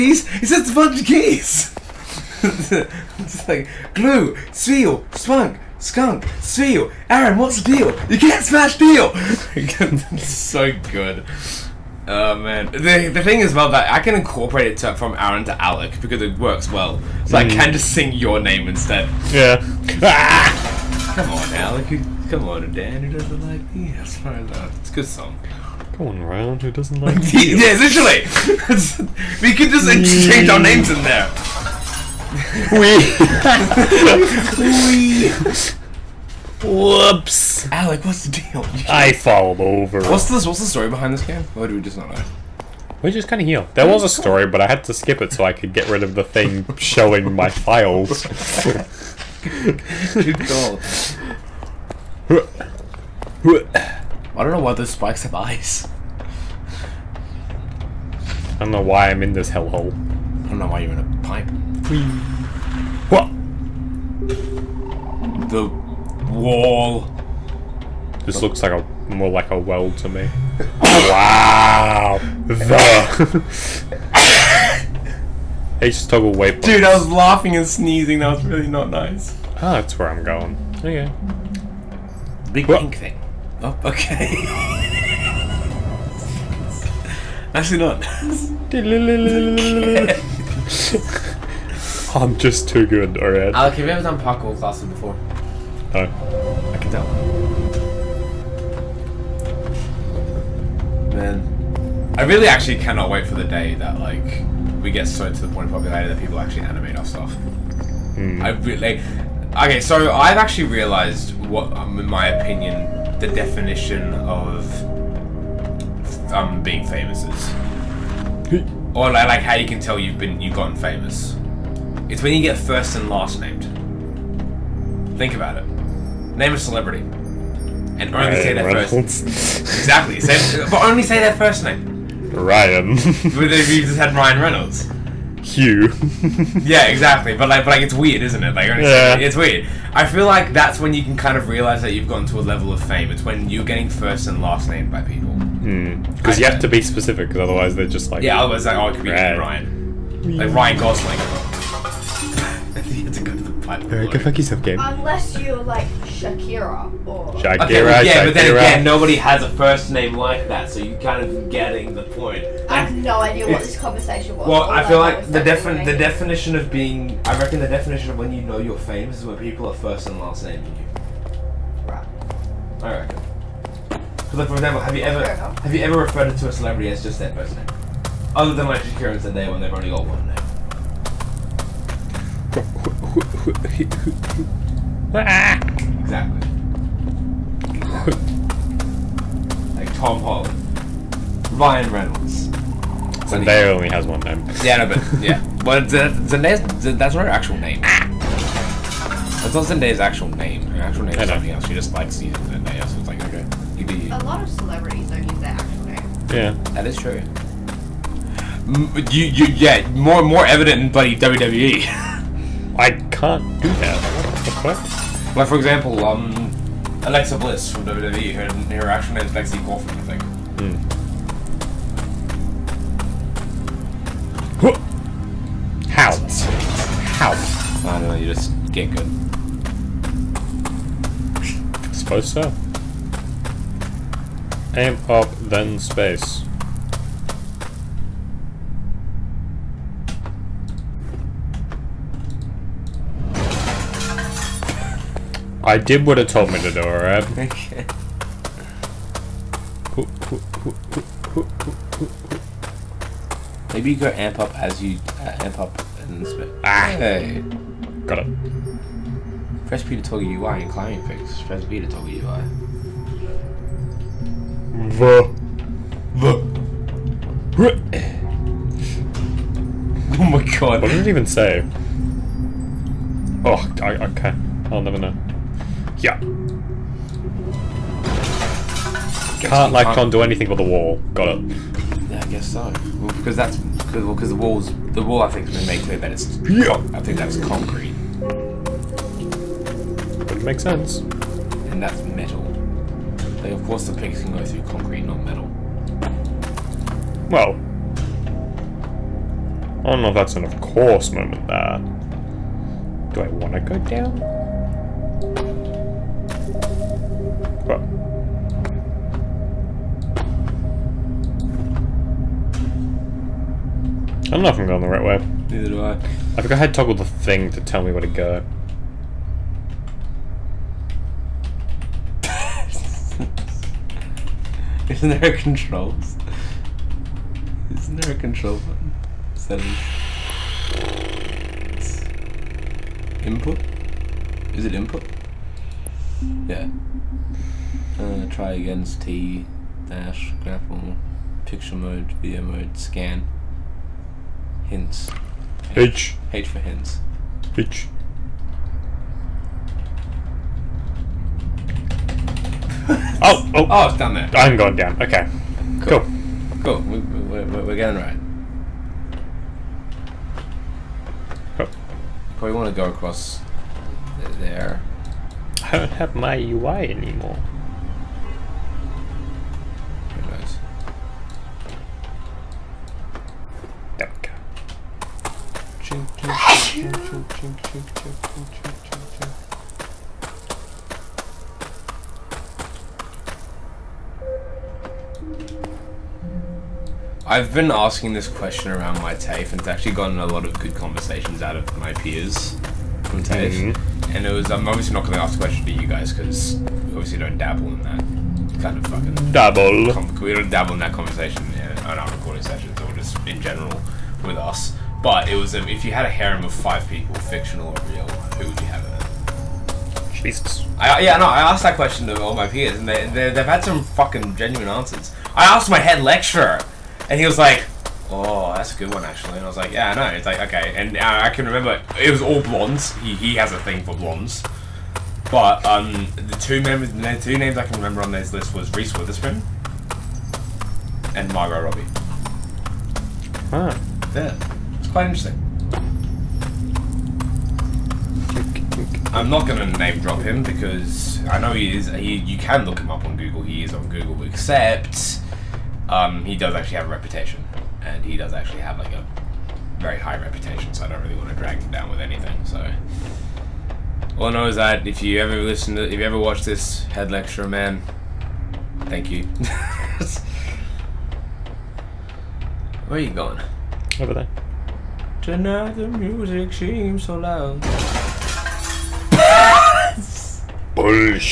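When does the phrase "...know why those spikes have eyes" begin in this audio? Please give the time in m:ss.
0:54.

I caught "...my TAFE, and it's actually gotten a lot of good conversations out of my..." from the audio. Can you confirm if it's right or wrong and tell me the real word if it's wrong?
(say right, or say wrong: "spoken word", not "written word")
right.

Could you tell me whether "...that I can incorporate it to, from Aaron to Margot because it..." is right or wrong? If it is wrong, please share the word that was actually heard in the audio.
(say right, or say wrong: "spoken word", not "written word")
wrong: "Alec", not "Margot".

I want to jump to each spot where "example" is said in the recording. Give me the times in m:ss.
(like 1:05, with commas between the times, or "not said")
2:54, 3:35.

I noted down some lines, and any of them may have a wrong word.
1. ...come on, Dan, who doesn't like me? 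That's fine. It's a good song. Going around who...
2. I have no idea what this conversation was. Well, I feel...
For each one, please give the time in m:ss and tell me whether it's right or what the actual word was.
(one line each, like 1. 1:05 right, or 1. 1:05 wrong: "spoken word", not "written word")
1. 0:22 right
2. 2:42 right.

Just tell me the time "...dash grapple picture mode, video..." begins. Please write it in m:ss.
5:39.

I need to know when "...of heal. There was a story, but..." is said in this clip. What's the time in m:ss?
0:43.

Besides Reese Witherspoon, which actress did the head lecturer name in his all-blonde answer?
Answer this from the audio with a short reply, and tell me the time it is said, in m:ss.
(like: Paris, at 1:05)
Margot Robbie, at 7:11.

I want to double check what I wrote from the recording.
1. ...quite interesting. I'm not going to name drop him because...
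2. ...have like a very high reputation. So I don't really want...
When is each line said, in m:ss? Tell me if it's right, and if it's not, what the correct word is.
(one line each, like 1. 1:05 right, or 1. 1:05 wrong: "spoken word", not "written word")
1. 7:14 right
2. 7:28 right.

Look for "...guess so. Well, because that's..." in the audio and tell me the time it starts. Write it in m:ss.
4:42.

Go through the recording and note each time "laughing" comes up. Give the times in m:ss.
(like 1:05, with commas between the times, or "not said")
1:17.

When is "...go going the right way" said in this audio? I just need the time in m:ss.
5:14.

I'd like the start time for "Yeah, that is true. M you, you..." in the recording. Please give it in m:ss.
3:26.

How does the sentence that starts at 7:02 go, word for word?
He, he has a thing for blondes.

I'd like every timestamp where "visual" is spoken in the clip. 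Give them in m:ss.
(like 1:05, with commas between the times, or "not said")
not said.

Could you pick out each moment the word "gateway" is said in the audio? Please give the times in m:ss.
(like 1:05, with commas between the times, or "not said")
not said.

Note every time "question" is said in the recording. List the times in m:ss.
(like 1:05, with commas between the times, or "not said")
6:28, 6:35, 6:51.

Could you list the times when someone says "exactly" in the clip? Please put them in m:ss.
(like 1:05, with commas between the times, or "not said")
2:09, 2:16, 3:06.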